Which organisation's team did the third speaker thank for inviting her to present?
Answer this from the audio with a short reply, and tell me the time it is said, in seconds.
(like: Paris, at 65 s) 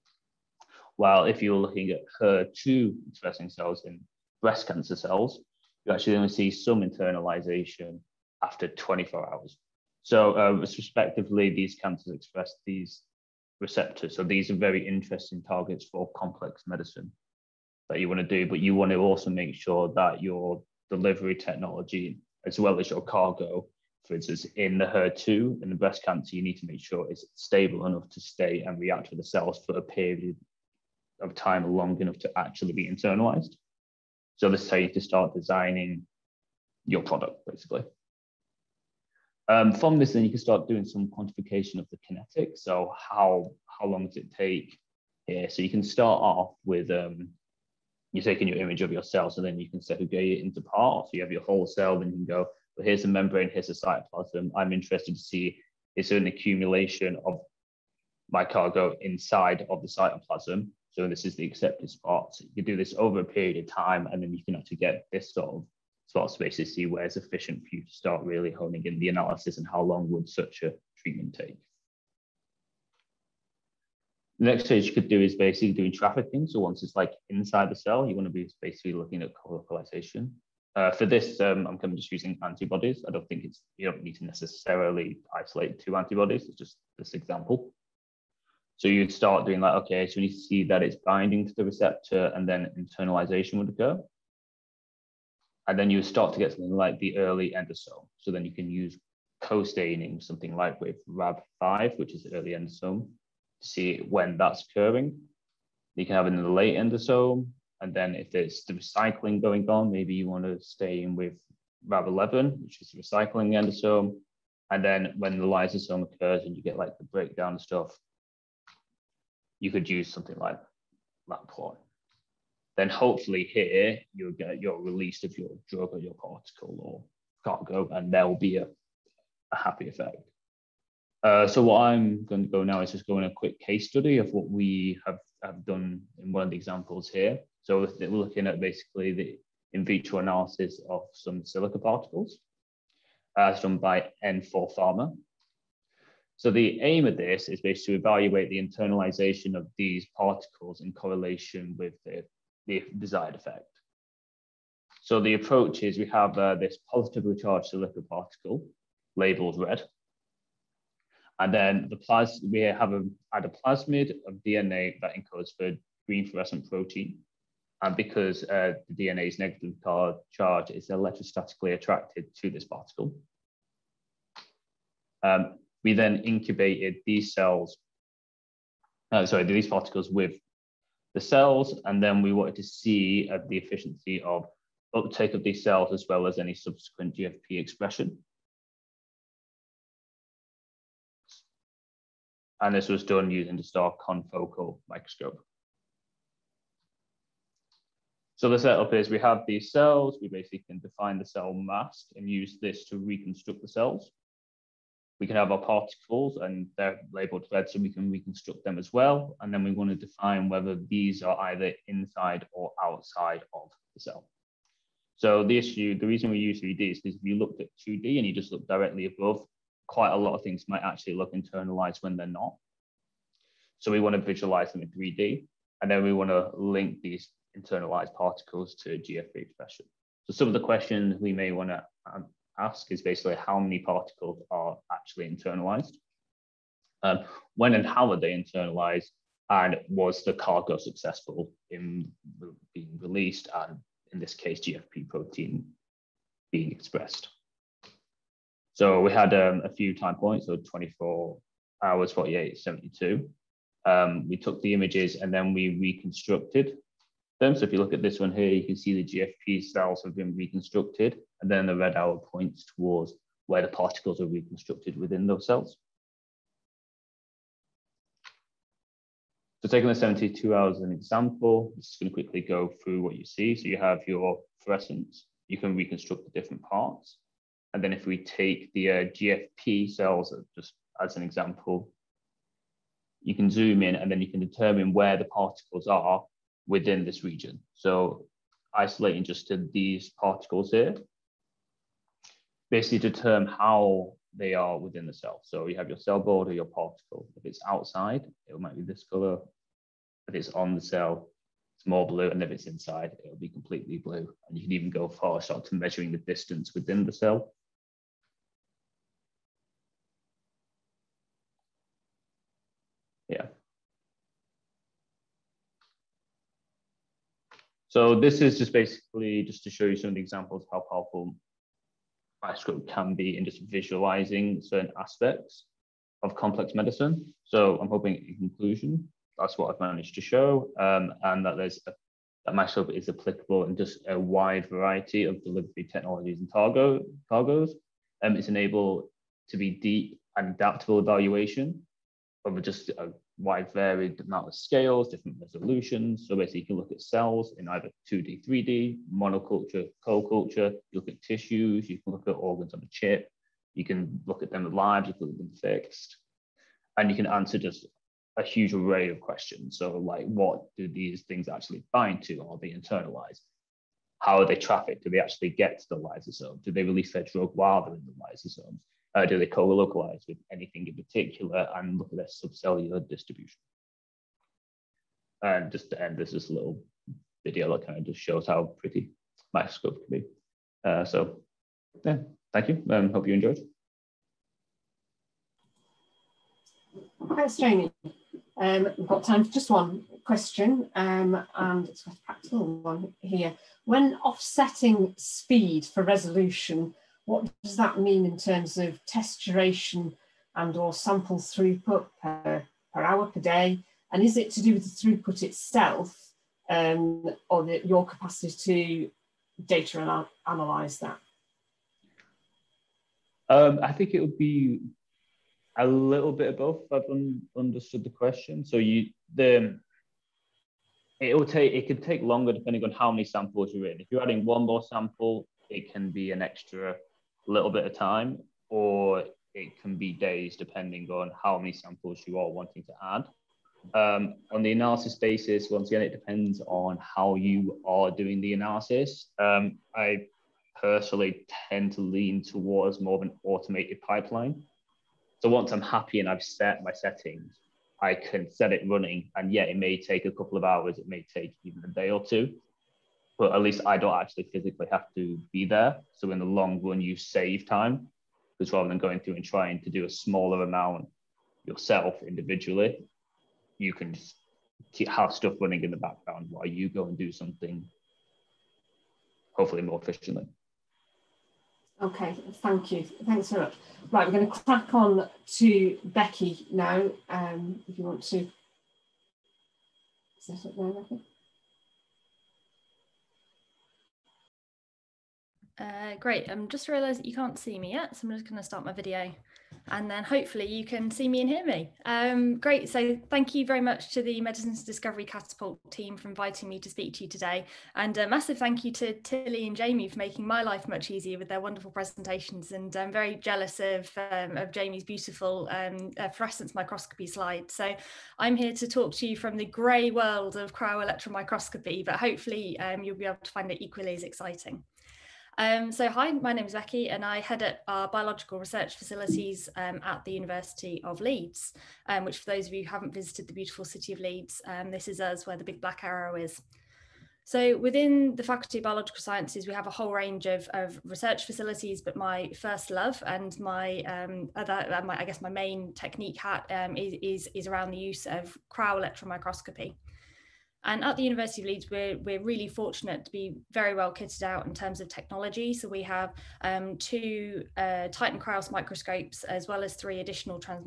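Medicines Discovery Catapult, at 494 s.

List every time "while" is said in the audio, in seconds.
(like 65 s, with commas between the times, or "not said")
0 s, 367 s, 466 s.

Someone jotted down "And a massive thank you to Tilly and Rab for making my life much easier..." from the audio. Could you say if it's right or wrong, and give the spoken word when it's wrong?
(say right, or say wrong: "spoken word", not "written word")
wrong: "Jamie", not "Rab".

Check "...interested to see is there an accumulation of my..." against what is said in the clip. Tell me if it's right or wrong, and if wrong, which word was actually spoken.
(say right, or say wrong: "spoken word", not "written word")
right.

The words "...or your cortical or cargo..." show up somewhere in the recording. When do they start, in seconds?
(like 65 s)
125 s.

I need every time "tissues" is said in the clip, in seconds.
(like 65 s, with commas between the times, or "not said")
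351 s.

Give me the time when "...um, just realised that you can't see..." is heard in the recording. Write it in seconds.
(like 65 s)
486 s.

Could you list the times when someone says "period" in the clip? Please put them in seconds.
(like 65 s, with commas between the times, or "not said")
29 s, 63 s.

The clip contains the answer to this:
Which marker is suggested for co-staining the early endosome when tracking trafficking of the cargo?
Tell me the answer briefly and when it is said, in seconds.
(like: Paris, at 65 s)
Rab5, at 101 s.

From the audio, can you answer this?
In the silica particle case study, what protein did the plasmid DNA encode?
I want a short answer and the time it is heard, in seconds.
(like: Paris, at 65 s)
green fluorescent protein, at 166 s.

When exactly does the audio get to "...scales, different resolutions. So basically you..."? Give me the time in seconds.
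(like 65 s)
344 s.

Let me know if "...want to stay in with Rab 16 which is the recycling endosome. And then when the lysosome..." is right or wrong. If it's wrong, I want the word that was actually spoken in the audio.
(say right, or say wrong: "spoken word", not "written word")
wrong: "11", not "16".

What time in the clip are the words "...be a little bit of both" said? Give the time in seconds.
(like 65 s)
414 s.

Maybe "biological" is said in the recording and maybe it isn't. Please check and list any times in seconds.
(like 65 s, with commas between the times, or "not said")
518 s, 528 s.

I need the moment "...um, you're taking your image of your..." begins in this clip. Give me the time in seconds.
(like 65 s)
46 s.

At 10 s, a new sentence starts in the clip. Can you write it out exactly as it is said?
So uh, respectively, these cancers express these receptors.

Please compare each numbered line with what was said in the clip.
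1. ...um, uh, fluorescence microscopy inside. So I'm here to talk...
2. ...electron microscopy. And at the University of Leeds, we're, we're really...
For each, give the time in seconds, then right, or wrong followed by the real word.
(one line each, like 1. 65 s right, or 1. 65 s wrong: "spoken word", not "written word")
1. 505 s wrong: "slide", not "inside"
2. 538 s right.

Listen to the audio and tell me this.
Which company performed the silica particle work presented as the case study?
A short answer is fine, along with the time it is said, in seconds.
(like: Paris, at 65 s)
N4 Pharma, at 144 s.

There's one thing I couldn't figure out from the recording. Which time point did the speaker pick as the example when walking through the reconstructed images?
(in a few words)
72 hours.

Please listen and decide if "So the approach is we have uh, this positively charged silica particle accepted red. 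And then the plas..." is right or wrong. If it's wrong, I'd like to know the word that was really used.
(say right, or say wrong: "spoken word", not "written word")
wrong: "labeled", not "accepted".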